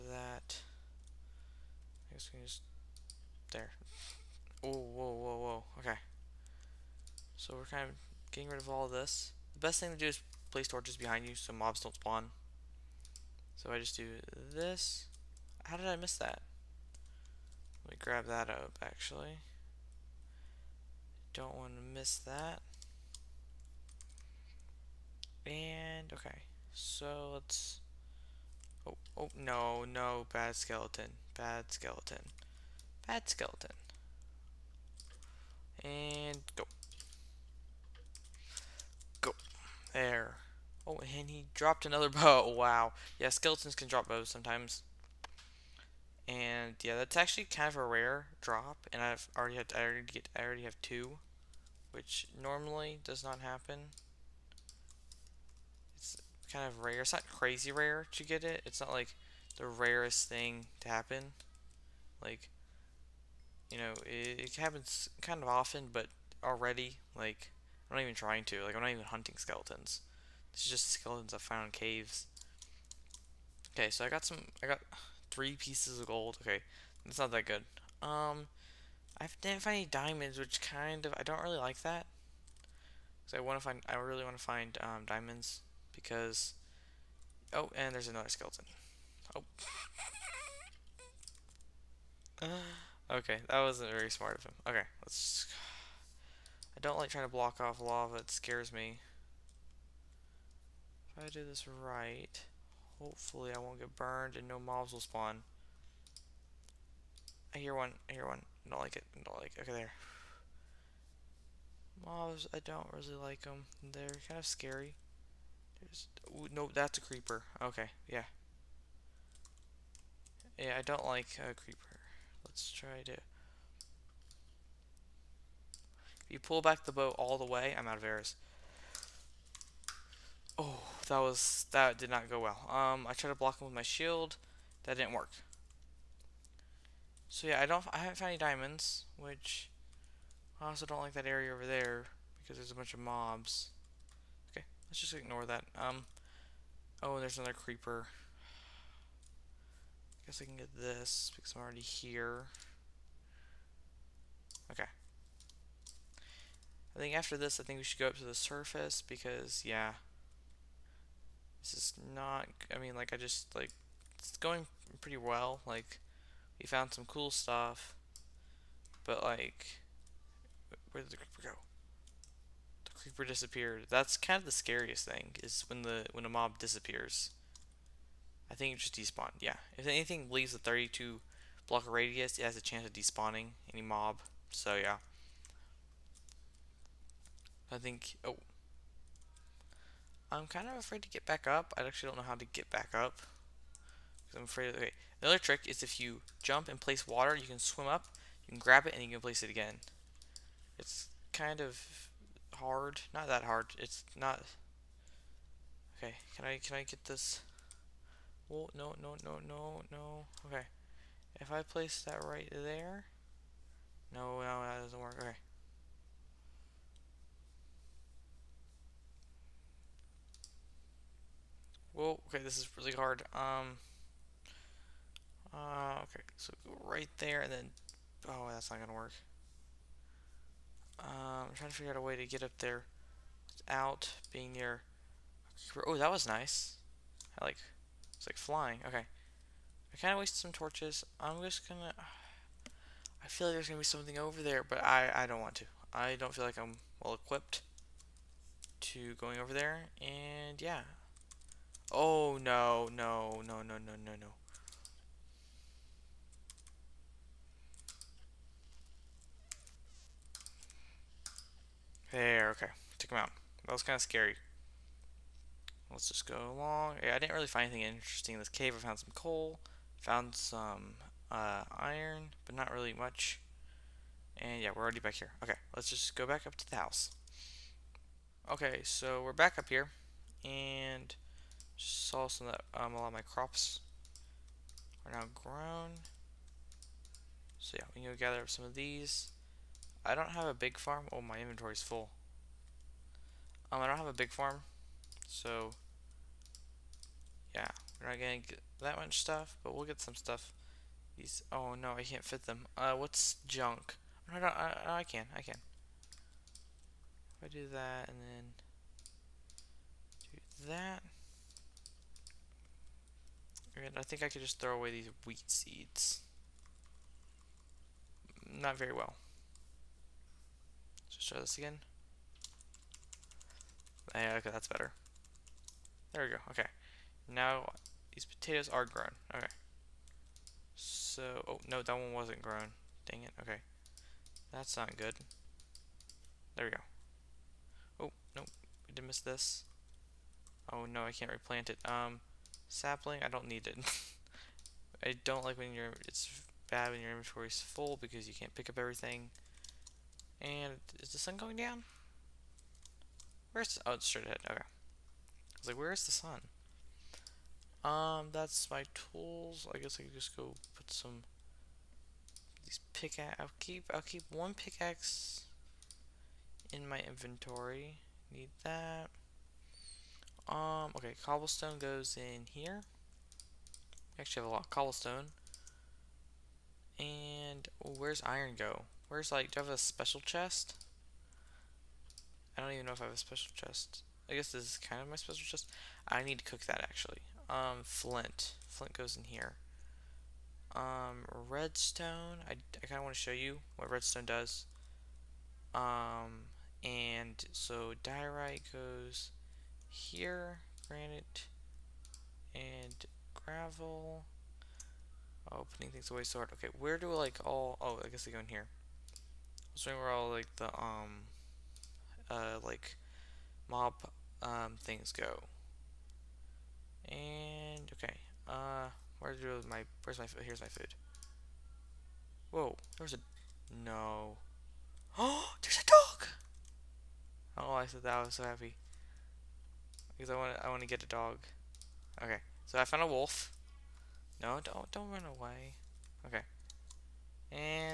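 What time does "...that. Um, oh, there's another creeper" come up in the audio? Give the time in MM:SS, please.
02:25.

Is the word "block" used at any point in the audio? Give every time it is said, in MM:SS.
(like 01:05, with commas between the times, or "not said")
01:37, 02:13, 03:01.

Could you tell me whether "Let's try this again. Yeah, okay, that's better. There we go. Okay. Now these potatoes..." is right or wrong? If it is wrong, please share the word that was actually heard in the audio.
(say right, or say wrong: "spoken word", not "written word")
right.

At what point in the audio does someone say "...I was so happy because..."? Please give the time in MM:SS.
07:08.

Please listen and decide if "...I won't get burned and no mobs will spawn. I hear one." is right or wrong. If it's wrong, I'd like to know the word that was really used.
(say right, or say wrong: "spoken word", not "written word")
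right.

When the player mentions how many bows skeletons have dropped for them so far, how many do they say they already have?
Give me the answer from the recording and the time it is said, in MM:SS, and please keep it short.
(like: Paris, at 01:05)
2, at 00:50.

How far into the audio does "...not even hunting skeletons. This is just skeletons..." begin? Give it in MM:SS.
01:08.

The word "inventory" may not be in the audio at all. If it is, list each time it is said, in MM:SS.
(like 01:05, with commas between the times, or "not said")
04:51, 05:47, 06:06.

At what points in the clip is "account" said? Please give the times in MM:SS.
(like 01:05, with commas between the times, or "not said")
not said.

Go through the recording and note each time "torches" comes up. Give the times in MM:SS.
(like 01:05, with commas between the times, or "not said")
00:10, 04:00.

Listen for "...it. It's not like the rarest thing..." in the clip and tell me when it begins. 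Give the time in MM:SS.
00:58.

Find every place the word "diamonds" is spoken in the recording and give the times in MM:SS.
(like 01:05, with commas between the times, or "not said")
01:19, 01:25, 02:18.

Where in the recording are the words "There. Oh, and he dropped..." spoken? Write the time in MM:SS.
00:39.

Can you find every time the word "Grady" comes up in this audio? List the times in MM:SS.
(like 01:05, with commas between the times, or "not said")
not said.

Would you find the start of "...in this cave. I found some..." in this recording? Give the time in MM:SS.
04:28.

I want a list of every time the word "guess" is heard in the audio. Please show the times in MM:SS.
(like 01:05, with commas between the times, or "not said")
00:02, 02:30, 05:59, 06:24, 06:48.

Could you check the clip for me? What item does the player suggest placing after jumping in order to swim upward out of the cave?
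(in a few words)
Water.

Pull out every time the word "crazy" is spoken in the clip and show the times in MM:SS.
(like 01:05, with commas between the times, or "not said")
00:57.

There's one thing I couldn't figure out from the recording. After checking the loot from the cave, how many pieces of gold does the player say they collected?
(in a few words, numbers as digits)
3.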